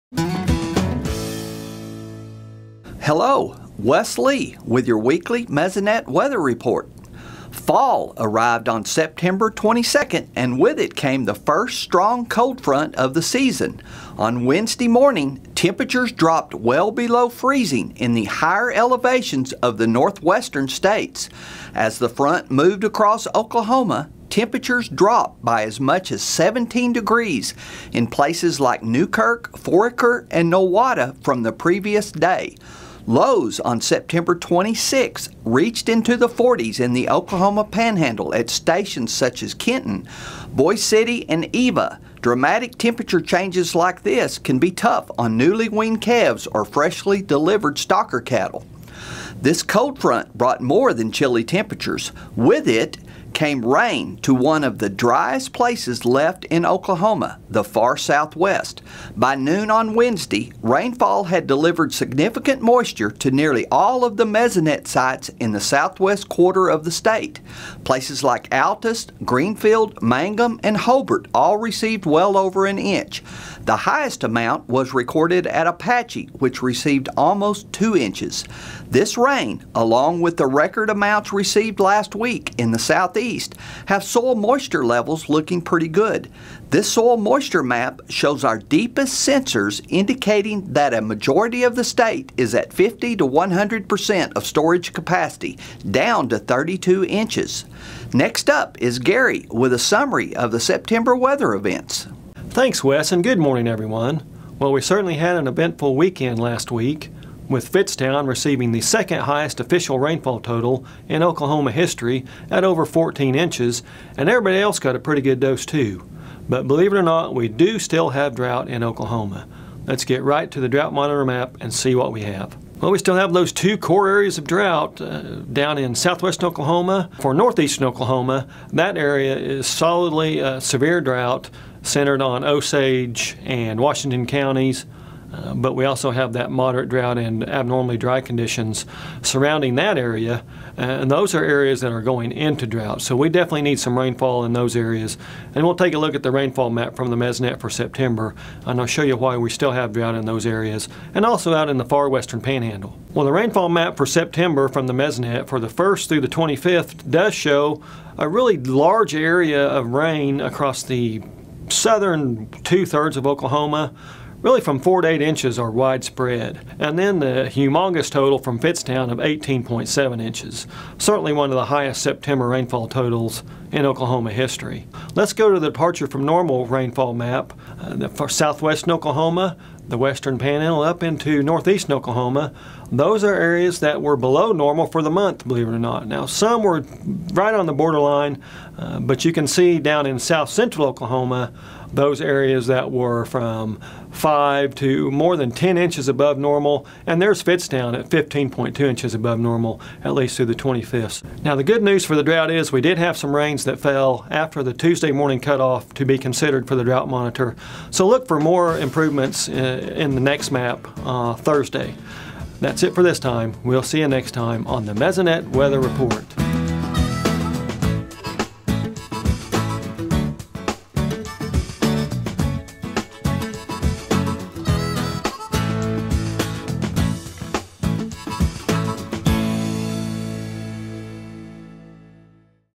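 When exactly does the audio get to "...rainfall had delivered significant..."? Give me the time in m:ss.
1:00.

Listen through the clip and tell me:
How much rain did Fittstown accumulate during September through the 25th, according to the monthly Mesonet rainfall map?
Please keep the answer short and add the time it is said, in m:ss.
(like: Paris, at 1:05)
18.7 inches, at 2:49.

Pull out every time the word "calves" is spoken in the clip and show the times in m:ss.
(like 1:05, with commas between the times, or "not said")
0:46.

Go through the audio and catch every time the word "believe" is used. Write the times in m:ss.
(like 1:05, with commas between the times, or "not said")
1:56, 3:05.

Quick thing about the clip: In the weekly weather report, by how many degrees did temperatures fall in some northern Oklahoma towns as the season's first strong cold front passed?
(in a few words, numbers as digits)
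17 degrees.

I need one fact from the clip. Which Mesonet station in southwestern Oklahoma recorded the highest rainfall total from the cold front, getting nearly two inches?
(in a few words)
Apache.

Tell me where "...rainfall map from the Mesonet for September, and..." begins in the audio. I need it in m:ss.
2:26.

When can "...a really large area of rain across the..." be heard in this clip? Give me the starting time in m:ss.
2:38.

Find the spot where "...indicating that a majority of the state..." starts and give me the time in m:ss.
1:29.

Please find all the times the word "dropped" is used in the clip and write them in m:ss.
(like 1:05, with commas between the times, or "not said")
0:16, 0:24.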